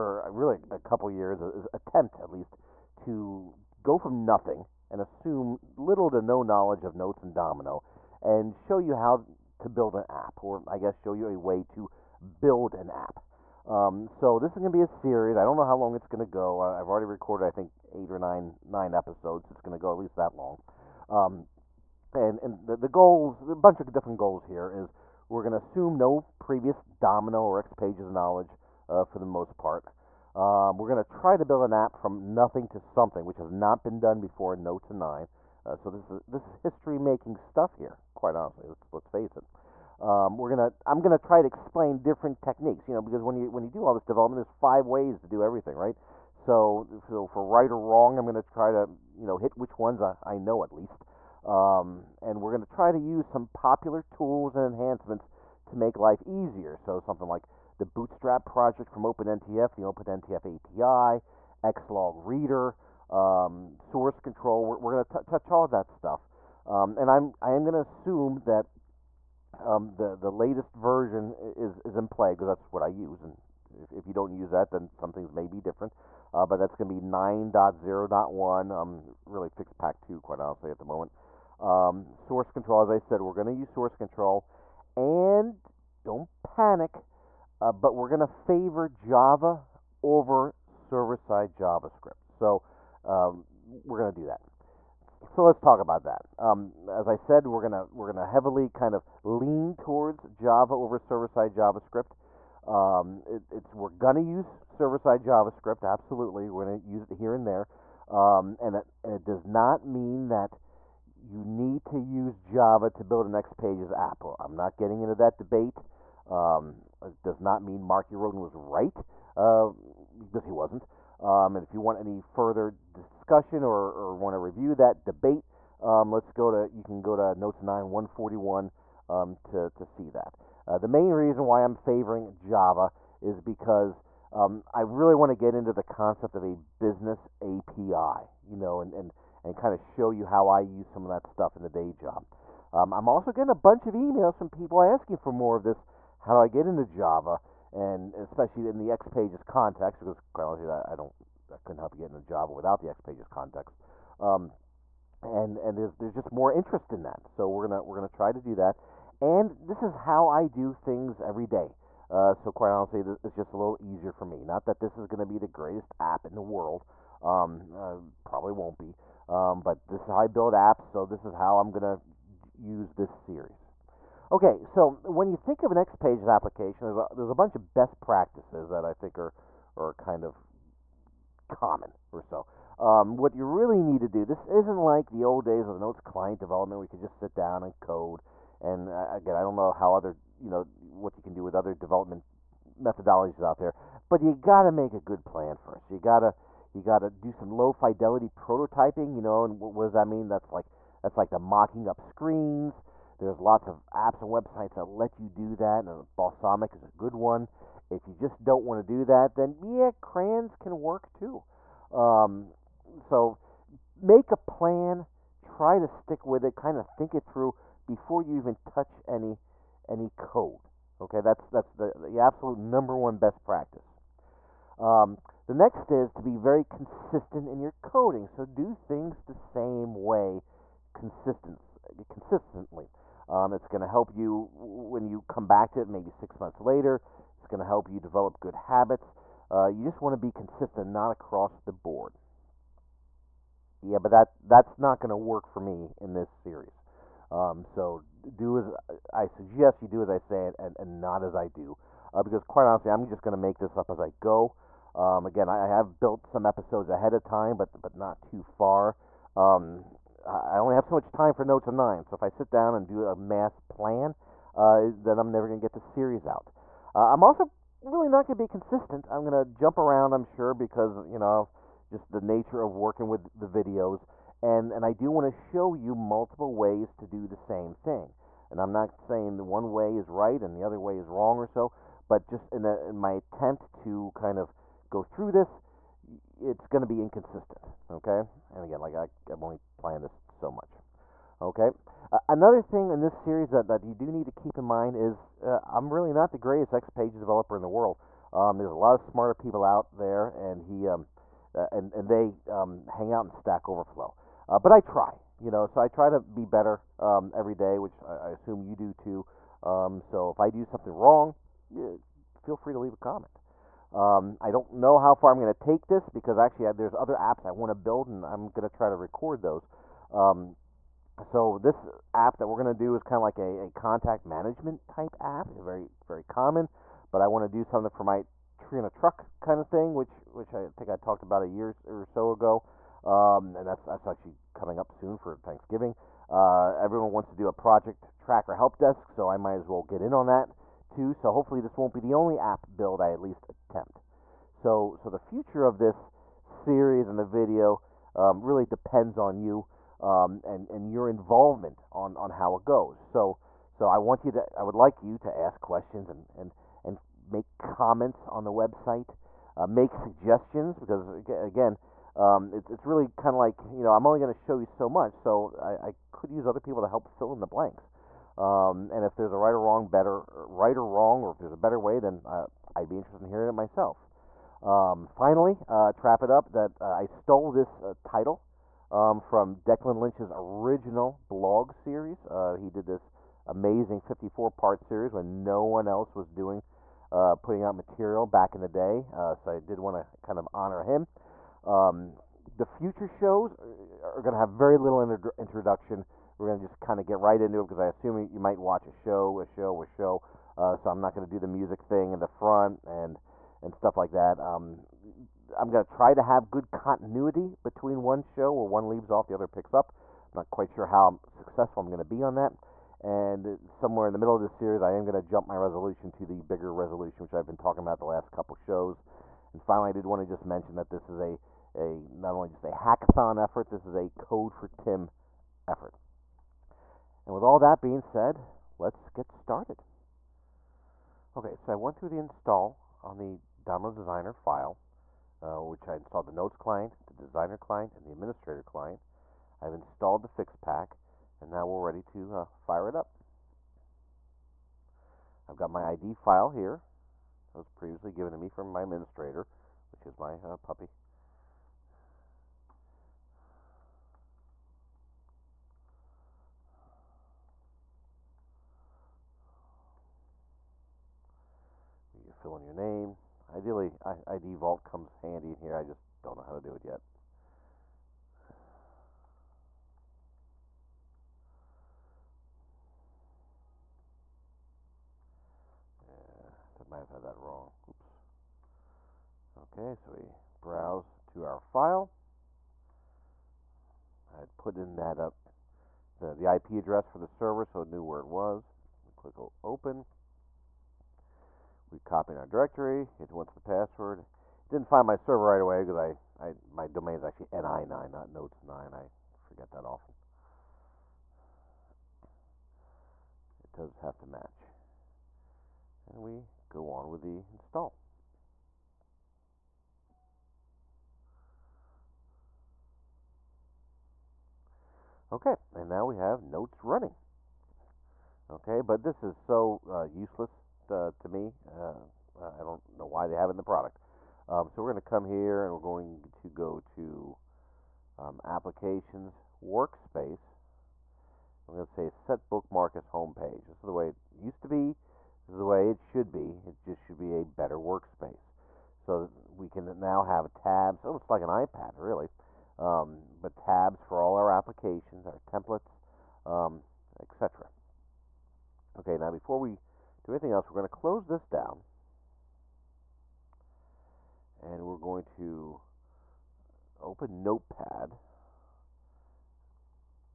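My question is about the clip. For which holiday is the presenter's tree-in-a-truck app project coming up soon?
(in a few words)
Thanksgiving.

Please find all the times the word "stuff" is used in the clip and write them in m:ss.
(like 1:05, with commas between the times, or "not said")
0:37, 1:05, 2:21, 6:43.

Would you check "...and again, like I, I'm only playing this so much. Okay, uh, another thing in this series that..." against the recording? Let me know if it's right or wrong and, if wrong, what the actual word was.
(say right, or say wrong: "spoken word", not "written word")
right.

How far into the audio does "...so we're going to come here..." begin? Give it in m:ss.
8:44.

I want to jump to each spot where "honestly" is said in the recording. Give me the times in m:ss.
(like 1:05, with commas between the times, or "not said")
0:38, 1:20, 2:30, 2:42, 4:12.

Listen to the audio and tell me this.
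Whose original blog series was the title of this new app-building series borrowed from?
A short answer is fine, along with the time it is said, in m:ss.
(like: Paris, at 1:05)
Declan Lynch, at 6:19.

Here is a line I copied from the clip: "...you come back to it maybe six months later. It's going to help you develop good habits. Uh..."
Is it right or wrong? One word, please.
right.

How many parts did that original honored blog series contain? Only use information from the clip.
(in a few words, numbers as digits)
54.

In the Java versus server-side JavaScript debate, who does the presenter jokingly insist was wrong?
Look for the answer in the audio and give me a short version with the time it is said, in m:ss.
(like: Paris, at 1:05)
Mark Roden, at 1:57.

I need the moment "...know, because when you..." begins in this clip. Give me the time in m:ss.
0:42.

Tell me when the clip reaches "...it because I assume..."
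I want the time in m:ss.
6:37.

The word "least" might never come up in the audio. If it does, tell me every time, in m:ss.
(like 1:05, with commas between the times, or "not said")
0:02, 0:19, 0:50, 5:43.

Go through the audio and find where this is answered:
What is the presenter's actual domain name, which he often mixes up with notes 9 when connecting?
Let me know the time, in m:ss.
8:17.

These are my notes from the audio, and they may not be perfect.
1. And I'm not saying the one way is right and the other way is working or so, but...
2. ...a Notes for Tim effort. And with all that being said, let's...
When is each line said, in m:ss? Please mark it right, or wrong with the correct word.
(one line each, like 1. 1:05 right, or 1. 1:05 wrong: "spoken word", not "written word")
1. 4:38 wrong: "wrong", not "working"
2. 7:03 wrong: "Code", not "Notes".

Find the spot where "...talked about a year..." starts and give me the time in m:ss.
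5:30.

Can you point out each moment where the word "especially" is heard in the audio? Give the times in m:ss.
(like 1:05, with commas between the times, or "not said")
2:28.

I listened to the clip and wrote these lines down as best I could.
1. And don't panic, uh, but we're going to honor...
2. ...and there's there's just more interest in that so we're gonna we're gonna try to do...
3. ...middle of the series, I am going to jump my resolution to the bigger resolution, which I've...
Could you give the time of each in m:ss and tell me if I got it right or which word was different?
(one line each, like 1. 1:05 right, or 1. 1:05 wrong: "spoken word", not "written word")
1. 1:24 wrong: "favor", not "honor"
2. 2:35 right
3. 6:54 right.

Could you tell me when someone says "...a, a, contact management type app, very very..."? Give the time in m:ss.
5:23.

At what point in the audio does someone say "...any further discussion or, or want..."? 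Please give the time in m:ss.
2:01.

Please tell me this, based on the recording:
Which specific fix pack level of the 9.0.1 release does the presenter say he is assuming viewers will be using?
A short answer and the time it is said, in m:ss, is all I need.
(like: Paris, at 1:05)
Fix pack 2, at 1:19.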